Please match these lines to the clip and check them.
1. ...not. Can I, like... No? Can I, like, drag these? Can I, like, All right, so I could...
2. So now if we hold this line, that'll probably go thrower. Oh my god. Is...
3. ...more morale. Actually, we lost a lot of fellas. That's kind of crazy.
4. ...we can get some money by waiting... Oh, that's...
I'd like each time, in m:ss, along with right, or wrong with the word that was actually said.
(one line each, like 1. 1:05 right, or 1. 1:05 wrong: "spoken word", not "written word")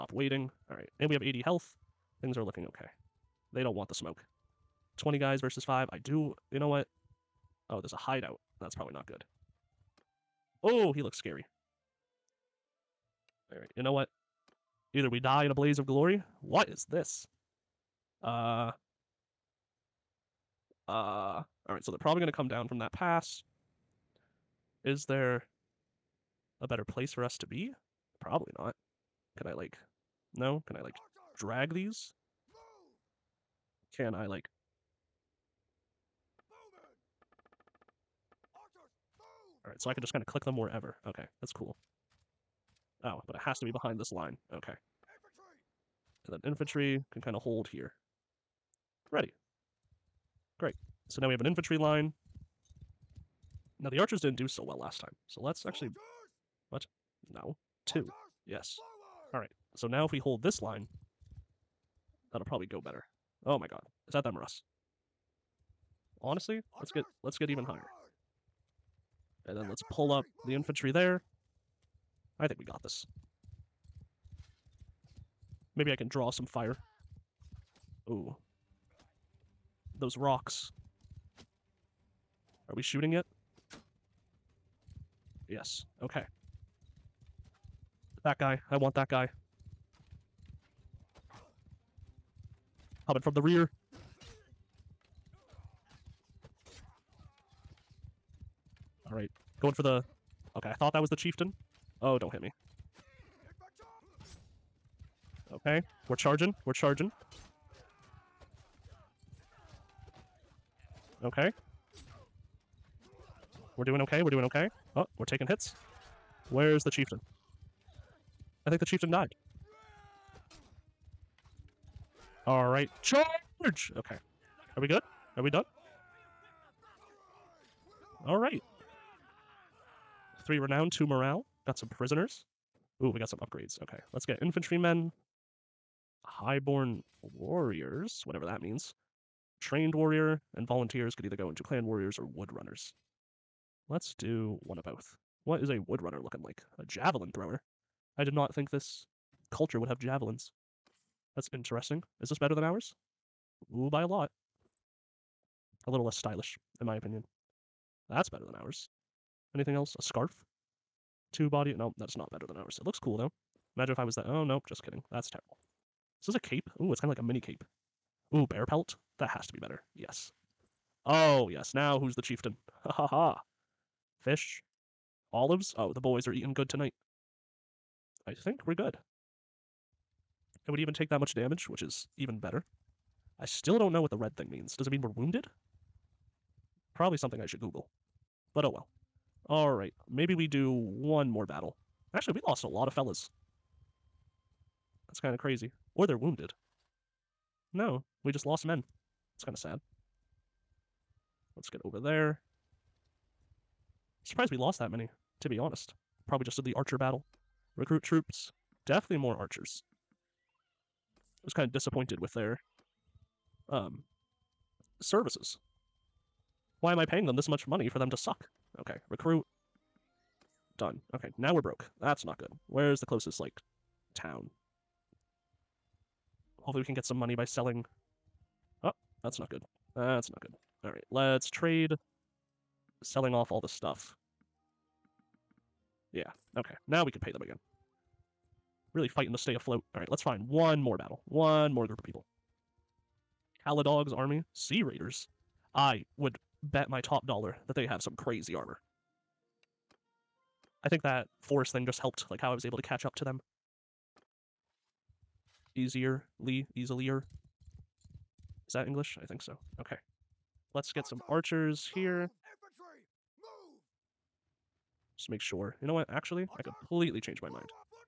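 1. 0:28 right
2. 0:59 wrong: "better", not "thrower"
3. 3:11 wrong: "battle", not "morale"
4. 3:46 wrong: "selling", not "waiting".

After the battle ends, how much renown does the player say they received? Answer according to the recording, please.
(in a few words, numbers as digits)
3.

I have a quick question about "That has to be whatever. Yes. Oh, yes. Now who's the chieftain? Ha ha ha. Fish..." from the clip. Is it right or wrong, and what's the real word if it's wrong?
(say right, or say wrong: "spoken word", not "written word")
wrong: "better", not "whatever".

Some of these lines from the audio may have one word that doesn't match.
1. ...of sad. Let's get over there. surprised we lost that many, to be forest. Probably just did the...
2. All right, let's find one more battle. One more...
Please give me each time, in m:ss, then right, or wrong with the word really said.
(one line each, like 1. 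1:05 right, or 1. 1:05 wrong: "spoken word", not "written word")
1. 3:19 wrong: "honest", not "forest"
2. 3:59 right.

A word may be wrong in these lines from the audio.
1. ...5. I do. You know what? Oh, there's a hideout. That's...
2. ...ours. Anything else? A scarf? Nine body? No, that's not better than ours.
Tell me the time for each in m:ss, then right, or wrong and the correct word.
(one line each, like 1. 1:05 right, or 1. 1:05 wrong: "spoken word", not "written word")
1. 0:05 right
2. 2:38 wrong: "Two", not "Nine".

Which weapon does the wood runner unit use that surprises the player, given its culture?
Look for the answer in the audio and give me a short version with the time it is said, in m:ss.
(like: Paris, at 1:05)
Javelins, at 2:26.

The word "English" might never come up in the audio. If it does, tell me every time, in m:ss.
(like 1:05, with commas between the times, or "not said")
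4:18.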